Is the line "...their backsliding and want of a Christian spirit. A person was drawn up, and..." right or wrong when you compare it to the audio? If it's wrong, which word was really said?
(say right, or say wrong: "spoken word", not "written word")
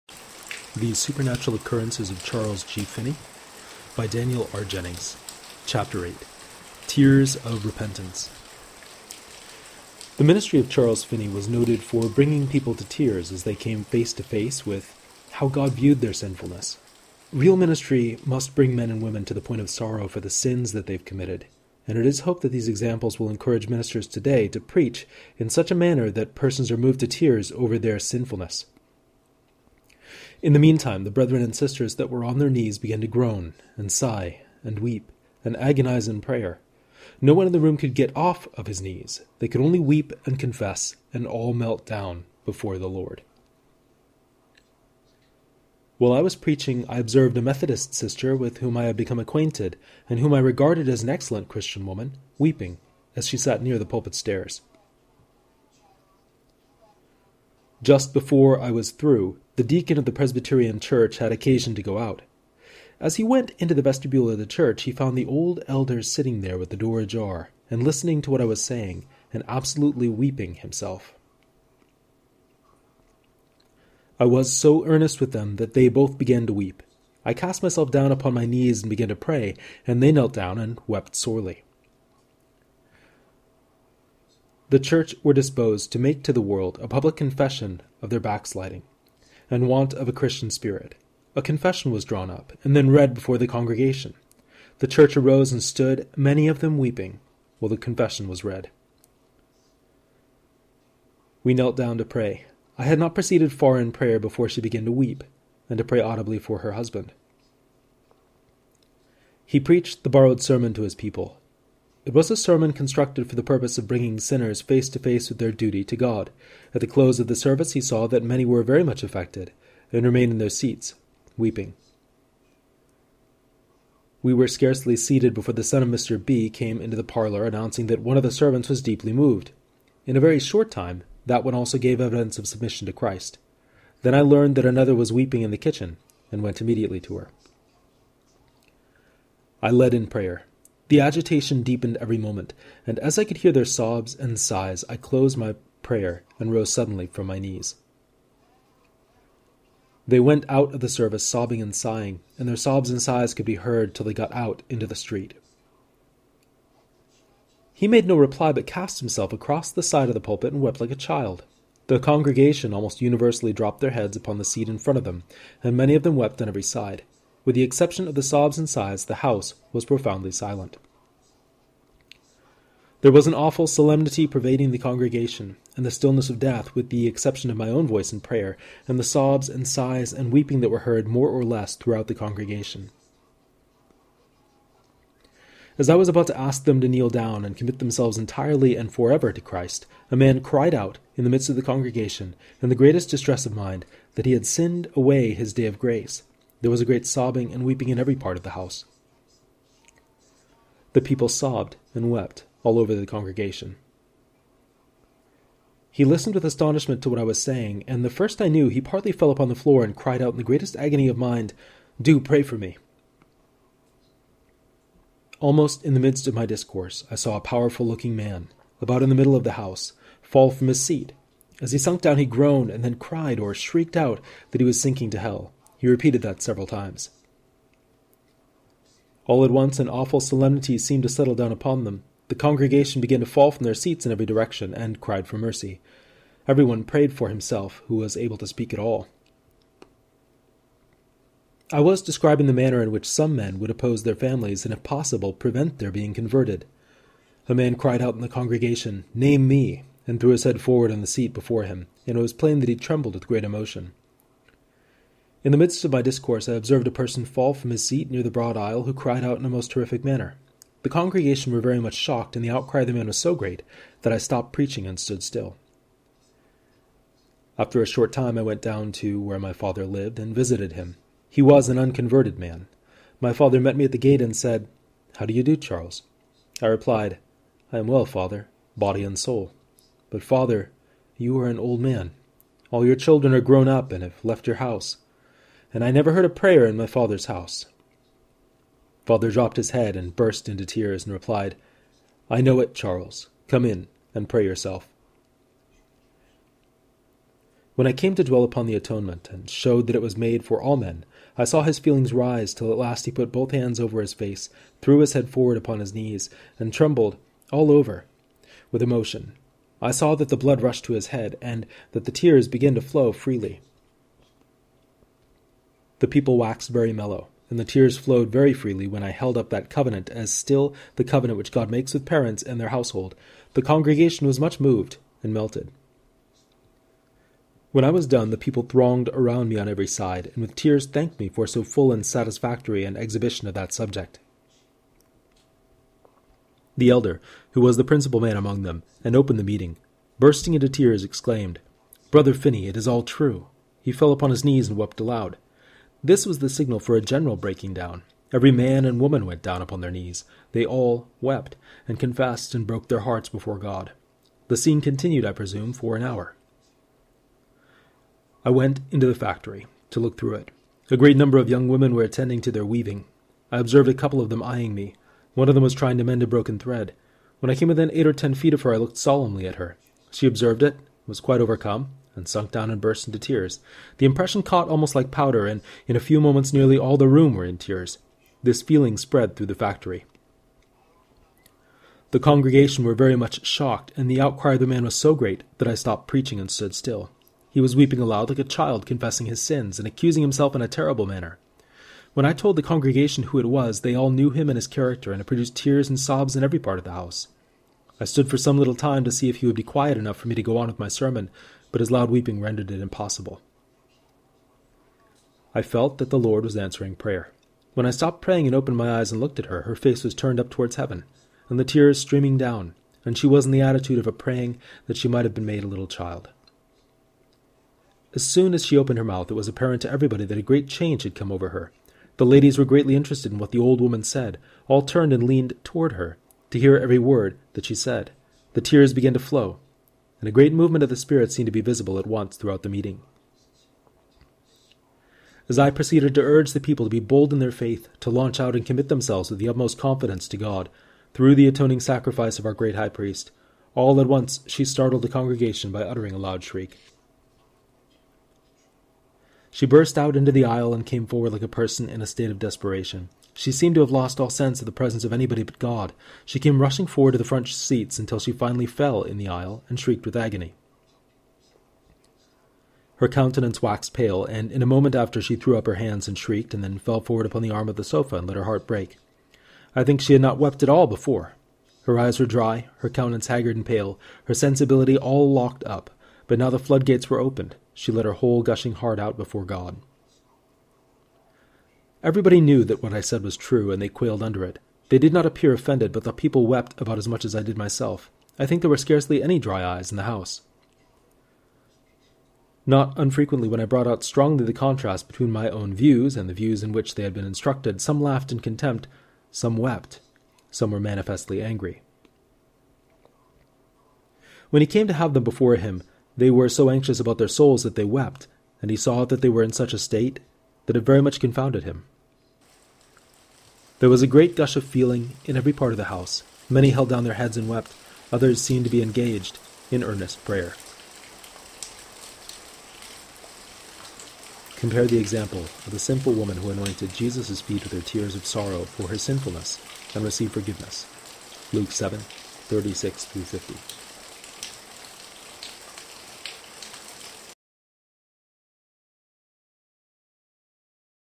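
wrong: "confession", not "person".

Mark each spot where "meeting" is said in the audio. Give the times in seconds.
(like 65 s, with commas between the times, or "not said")
339 s, 432 s.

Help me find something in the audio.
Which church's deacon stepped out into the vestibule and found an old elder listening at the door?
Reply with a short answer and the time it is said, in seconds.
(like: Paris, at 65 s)
Presbyterian, at 60 s.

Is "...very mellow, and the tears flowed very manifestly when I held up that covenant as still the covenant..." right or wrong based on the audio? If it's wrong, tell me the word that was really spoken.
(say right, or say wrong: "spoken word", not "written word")
wrong: "freely", not "manifestly".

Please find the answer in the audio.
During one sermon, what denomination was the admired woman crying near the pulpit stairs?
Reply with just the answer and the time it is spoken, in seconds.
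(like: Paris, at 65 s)
Methodist, at 47 s.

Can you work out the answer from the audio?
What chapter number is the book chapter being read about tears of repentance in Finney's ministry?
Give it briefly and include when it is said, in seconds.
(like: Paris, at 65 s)
8, at 5 s.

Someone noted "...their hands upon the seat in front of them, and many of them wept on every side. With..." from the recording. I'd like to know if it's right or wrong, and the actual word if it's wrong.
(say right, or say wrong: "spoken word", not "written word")
wrong: "heads", not "hands".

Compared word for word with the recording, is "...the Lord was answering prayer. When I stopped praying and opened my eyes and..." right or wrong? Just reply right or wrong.
right.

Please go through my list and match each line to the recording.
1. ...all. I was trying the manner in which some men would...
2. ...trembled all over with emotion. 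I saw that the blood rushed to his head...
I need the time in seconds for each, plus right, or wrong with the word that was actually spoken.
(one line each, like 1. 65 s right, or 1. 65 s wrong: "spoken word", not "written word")
1. 238 s wrong: "describing", not "trying"
2. 306 s right.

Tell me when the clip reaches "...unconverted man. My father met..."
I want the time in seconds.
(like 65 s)
271 s.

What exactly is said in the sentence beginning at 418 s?
As soon as she opened her mouth, it was apparent to everybody that a great change had come over her.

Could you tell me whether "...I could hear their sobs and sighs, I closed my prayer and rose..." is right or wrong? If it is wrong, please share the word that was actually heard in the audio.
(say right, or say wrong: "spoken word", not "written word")
right.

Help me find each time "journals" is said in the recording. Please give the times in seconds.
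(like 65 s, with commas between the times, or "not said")
not said.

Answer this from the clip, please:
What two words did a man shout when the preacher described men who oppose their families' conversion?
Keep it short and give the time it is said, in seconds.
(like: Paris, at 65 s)
Name me, at 249 s.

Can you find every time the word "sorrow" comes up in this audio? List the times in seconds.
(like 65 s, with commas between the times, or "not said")
19 s, 528 s.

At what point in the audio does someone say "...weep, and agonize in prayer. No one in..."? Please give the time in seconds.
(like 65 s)
34 s.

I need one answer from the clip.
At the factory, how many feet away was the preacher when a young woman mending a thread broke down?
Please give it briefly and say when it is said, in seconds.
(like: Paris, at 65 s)
8 or 10 feet, at 367 s.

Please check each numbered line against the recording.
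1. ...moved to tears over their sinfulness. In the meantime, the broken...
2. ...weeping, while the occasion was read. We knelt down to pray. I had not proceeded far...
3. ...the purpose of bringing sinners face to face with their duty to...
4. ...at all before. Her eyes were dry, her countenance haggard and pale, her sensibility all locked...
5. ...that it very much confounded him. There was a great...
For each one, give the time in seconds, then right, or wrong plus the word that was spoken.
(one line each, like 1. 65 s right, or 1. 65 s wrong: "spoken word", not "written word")
1. 26 s wrong: "brethren", not "broken"
2. 96 s wrong: "confession", not "occasion"
3. 113 s right
4. 470 s right
5. 510 s right.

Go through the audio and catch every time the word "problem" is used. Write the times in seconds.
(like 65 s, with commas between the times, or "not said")
not said.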